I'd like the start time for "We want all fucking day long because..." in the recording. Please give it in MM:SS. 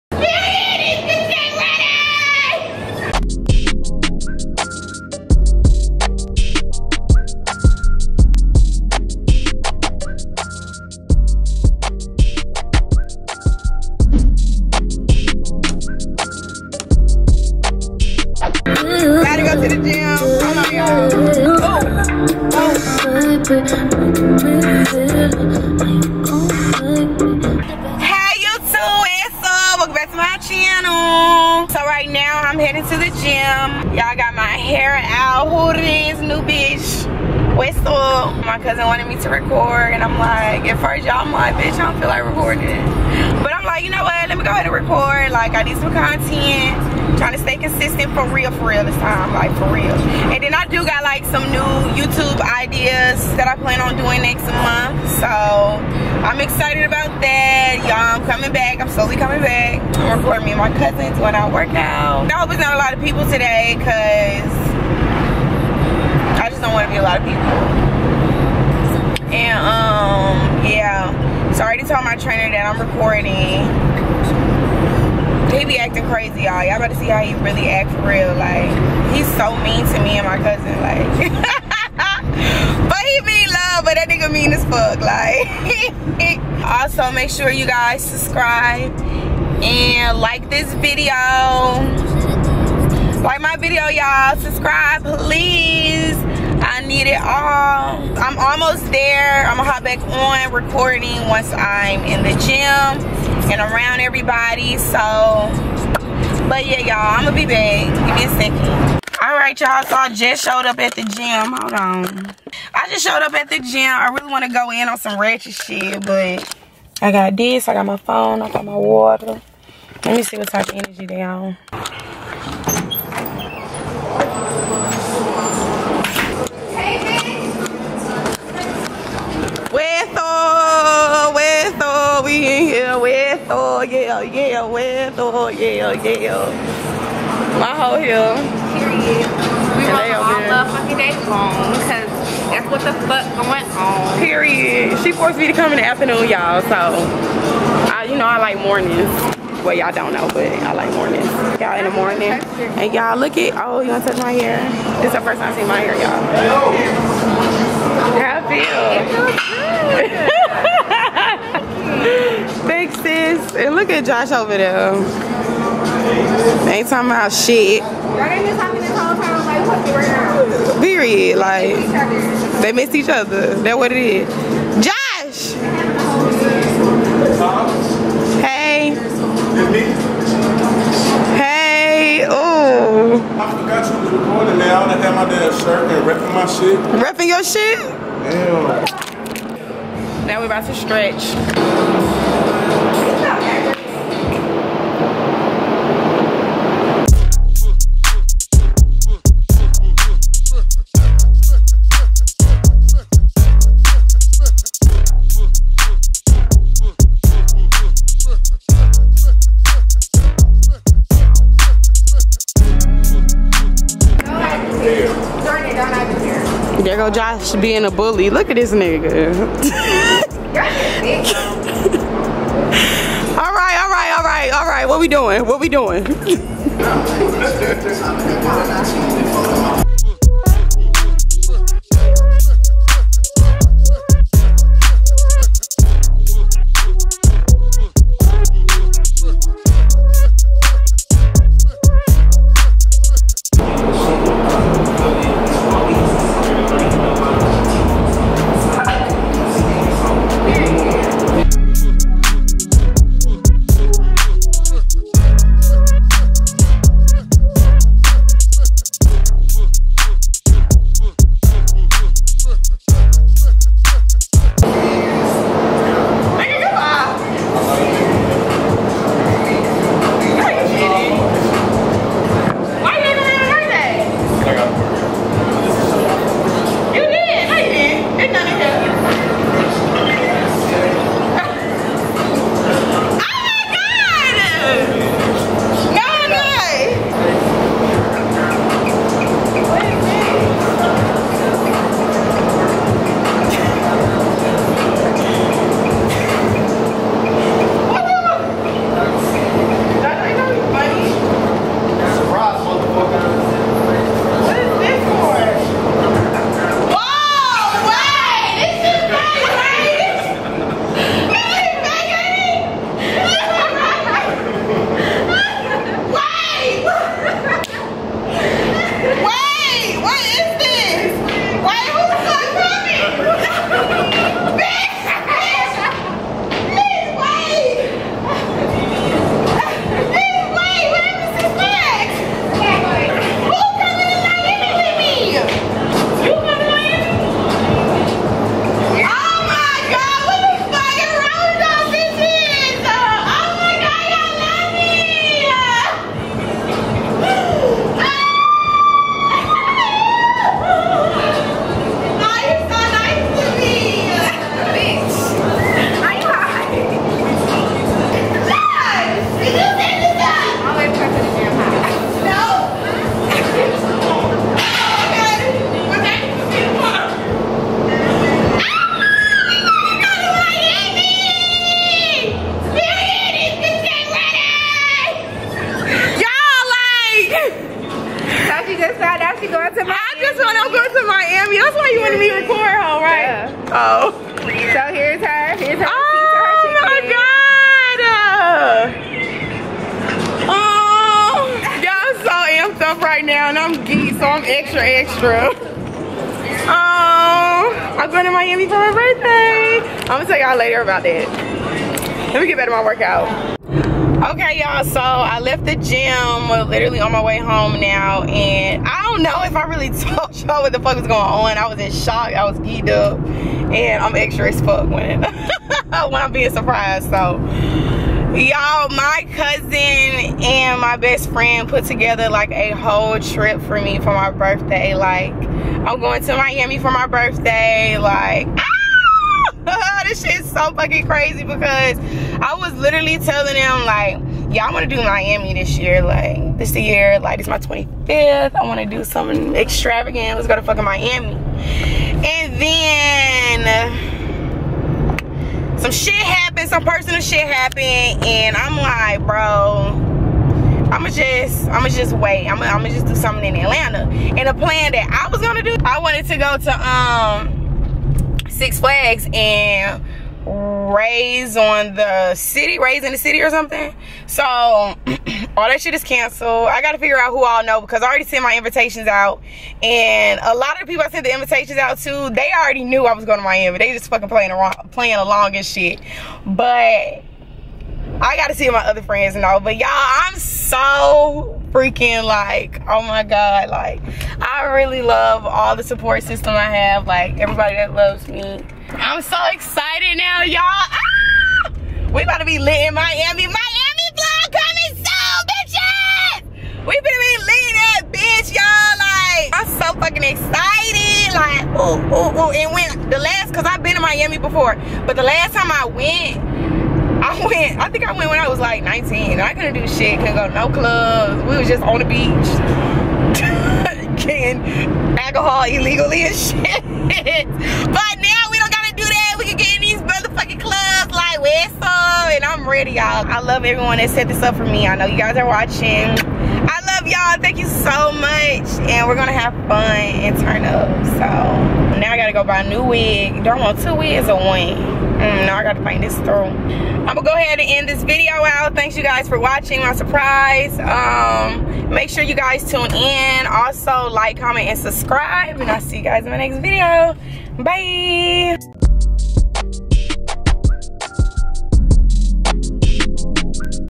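02:19.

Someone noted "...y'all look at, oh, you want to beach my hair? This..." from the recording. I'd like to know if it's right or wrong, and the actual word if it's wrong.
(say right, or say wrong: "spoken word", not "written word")
wrong: "touch", not "beach".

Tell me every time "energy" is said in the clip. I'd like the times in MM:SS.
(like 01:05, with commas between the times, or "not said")
02:00.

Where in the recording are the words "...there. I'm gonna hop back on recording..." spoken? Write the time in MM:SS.
01:38.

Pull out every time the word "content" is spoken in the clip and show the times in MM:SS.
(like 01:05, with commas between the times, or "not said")
00:45.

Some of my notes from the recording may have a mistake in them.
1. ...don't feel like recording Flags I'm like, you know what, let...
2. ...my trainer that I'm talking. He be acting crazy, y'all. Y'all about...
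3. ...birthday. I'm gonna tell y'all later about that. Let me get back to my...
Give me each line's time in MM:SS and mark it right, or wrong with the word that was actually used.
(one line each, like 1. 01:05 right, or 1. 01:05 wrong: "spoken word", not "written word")
1. 00:41 wrong: "But", not "Flags"
2. 01:12 wrong: "recording", not "talking"
3. 06:38 right.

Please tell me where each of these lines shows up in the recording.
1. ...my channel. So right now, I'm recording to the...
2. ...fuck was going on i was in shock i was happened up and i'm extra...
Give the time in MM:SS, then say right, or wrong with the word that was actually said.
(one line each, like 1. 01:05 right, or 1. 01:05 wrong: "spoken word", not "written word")
1. 00:30 wrong: "heading", not "recording"
2. 06:50 wrong: "geeked", not "happened".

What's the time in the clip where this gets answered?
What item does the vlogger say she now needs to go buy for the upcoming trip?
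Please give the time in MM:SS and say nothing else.
08:52.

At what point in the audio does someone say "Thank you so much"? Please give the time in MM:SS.
08:47.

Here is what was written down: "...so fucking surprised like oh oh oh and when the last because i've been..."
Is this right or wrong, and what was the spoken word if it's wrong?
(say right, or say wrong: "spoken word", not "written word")
wrong: "excited", not "surprised".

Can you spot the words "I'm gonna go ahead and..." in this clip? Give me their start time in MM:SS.
08:56.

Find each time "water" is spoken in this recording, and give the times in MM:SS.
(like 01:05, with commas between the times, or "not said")
01:58.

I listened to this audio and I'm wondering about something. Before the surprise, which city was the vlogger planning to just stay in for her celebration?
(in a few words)
Atlanta.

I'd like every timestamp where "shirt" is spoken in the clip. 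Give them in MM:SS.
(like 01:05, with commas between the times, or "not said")
03:05.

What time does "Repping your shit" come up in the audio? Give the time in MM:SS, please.
03:07.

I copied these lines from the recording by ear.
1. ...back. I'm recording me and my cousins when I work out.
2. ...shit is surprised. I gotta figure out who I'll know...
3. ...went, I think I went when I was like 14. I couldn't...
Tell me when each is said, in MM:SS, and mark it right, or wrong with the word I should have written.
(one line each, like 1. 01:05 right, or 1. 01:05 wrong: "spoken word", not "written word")
1. 00:59 right
2. 07:45 wrong: "canceled", not "surprised"
3. 08:27 wrong: "19", not "14".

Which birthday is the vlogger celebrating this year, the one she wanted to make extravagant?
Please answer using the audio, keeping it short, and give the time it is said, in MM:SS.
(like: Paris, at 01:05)
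25th, at 07:17.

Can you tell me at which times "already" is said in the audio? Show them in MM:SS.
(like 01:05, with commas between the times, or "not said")
01:11, 07:48, 07:52.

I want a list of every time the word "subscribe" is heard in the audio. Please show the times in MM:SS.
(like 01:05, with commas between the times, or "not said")
01:28, 01:34, 09:04.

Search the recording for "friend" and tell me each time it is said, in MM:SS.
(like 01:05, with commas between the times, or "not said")
07:01, 07:59.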